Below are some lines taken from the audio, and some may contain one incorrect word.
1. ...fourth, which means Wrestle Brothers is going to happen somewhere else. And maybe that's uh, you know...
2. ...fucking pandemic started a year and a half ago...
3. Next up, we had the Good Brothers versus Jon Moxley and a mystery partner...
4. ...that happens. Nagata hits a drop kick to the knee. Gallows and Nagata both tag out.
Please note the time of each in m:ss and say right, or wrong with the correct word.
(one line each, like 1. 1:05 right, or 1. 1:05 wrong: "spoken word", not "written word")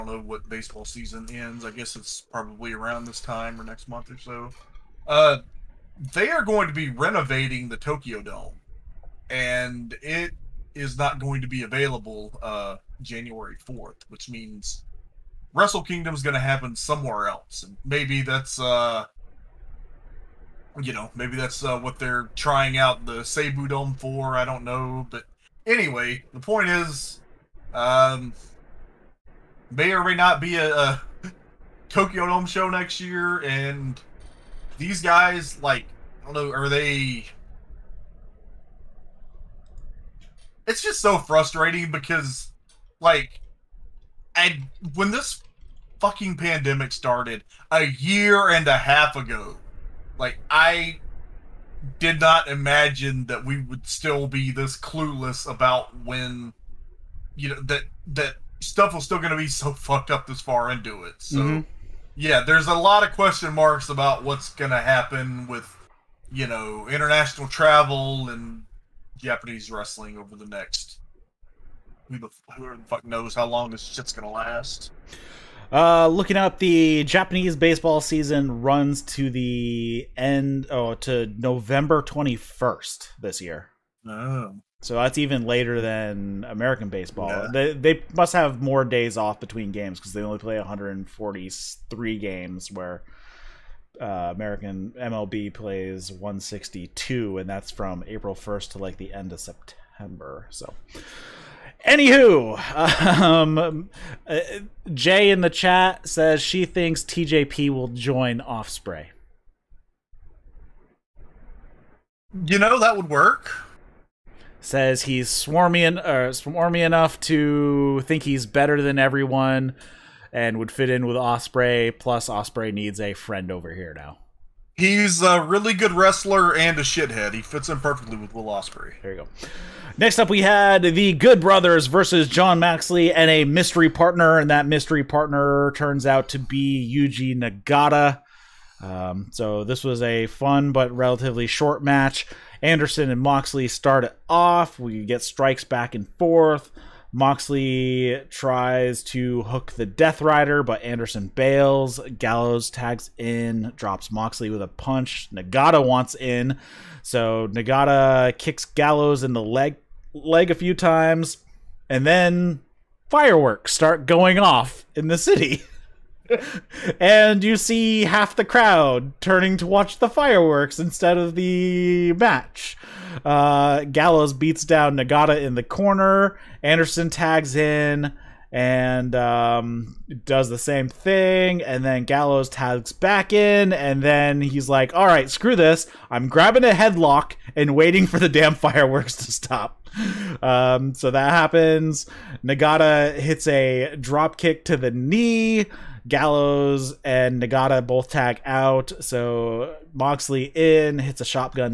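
1. 0:13 wrong: "Kingdom", not "Brothers"
2. 0:46 right
3. 2:09 right
4. 3:11 right.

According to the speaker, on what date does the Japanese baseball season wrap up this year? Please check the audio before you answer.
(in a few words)
November 21st.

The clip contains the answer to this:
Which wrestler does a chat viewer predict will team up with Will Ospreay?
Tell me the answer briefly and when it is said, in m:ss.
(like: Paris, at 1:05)
TJP, at 1:47.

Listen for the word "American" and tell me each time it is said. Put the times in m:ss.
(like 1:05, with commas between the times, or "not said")
1:26, 1:34.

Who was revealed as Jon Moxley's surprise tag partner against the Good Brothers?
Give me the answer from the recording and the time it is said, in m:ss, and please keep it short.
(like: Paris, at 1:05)
Yuji Nagata, at 2:16.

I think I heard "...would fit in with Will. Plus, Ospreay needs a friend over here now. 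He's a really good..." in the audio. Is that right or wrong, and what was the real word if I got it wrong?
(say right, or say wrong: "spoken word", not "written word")
wrong: "Ospreay", not "Will".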